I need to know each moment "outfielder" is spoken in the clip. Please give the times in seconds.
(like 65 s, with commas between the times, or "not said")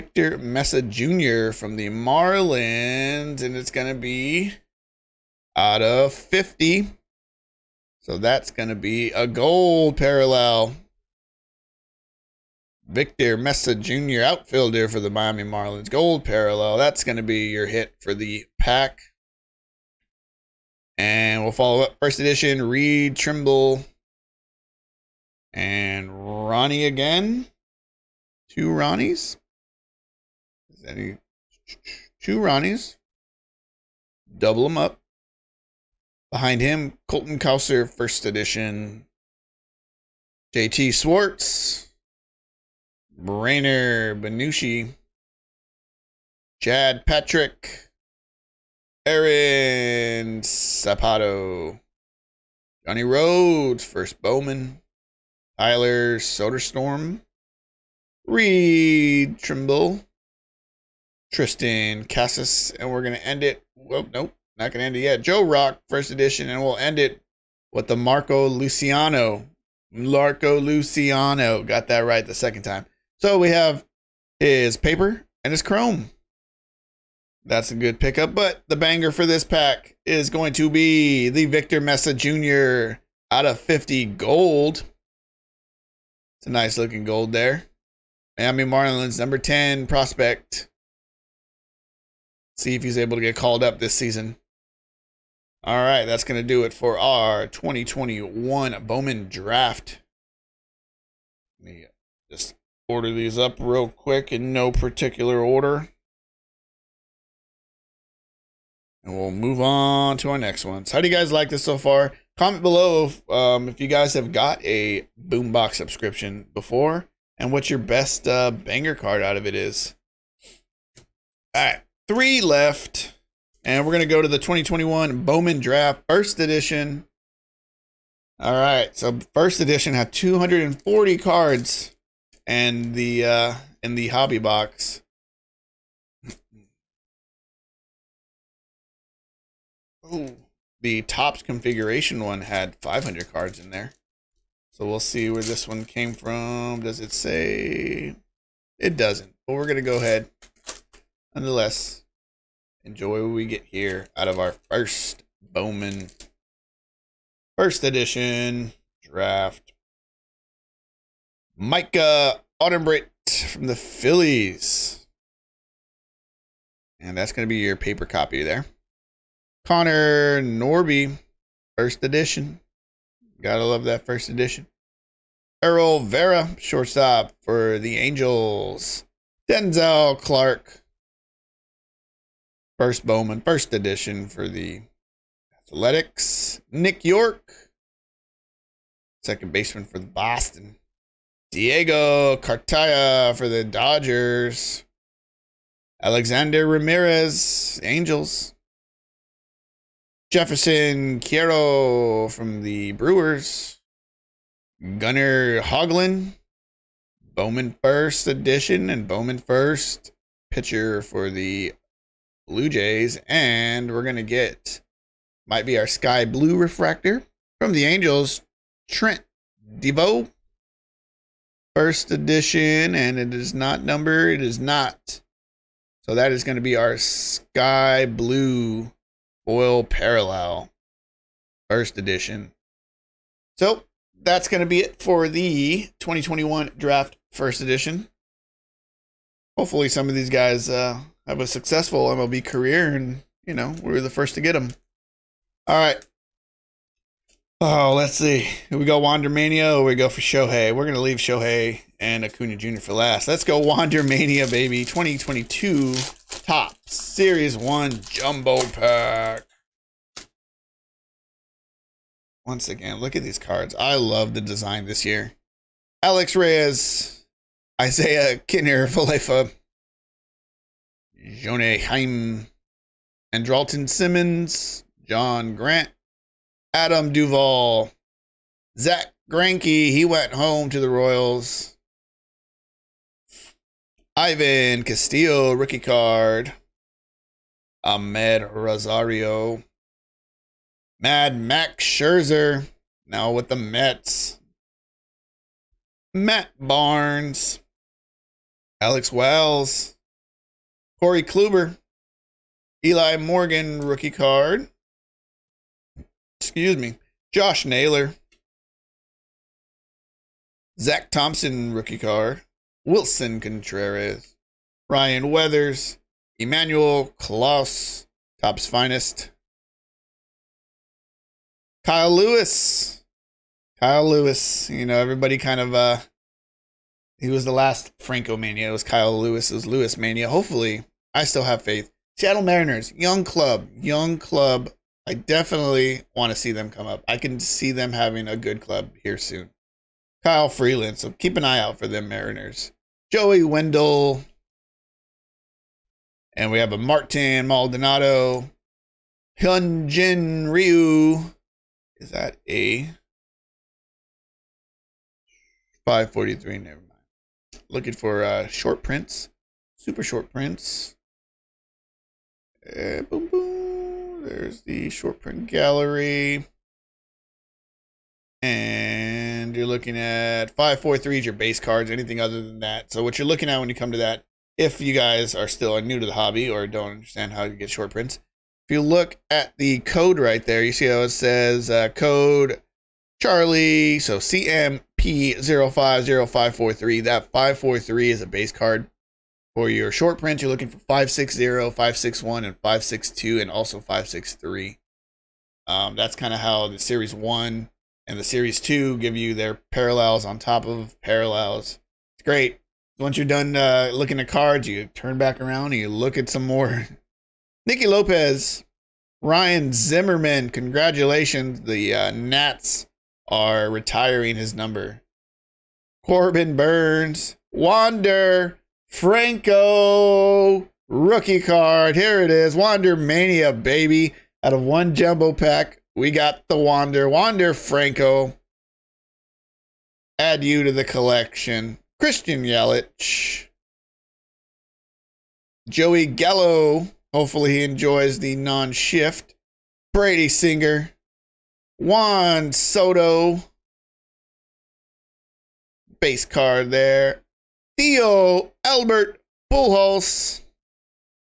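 14 s.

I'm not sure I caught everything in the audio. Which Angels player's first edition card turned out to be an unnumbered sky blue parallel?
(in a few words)
Trent Deveaux.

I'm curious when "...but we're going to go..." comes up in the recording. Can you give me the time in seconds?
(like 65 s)
149 s.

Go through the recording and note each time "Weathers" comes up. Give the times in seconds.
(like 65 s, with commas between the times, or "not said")
315 s.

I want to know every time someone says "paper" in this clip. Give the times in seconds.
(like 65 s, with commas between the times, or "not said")
74 s, 167 s.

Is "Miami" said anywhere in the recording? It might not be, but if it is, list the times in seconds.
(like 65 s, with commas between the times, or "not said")
15 s, 88 s.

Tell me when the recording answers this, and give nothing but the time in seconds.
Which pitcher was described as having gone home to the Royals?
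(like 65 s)
278 s.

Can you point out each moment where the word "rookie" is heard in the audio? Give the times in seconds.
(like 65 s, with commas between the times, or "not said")
285 s, 303 s, 311 s, 420 s.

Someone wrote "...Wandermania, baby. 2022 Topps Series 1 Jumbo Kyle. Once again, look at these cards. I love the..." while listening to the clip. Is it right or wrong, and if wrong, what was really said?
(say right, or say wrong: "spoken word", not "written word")
wrong: "Pack", not "Kyle".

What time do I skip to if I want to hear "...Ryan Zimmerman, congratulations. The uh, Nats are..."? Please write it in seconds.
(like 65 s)
409 s.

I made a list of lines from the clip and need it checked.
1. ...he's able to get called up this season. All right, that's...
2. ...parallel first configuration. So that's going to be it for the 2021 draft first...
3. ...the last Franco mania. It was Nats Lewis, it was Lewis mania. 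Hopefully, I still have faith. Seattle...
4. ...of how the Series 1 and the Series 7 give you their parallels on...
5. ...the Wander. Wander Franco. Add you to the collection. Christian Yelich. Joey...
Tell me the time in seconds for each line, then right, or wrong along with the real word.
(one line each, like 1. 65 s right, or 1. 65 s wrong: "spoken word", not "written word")
1. 92 s right
2. 229 s wrong: "edition", not "configuration"
3. 327 s wrong: "Kyle", not "Nats"
4. 396 s wrong: "2", not "7"
5. 426 s right.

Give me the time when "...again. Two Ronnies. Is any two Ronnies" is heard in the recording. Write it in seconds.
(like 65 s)
26 s.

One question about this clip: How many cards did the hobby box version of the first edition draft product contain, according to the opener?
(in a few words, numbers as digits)
240.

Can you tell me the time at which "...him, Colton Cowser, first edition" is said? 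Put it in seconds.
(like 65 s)
36 s.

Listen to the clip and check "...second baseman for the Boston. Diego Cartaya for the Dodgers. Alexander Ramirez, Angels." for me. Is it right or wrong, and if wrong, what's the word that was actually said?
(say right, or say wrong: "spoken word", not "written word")
right.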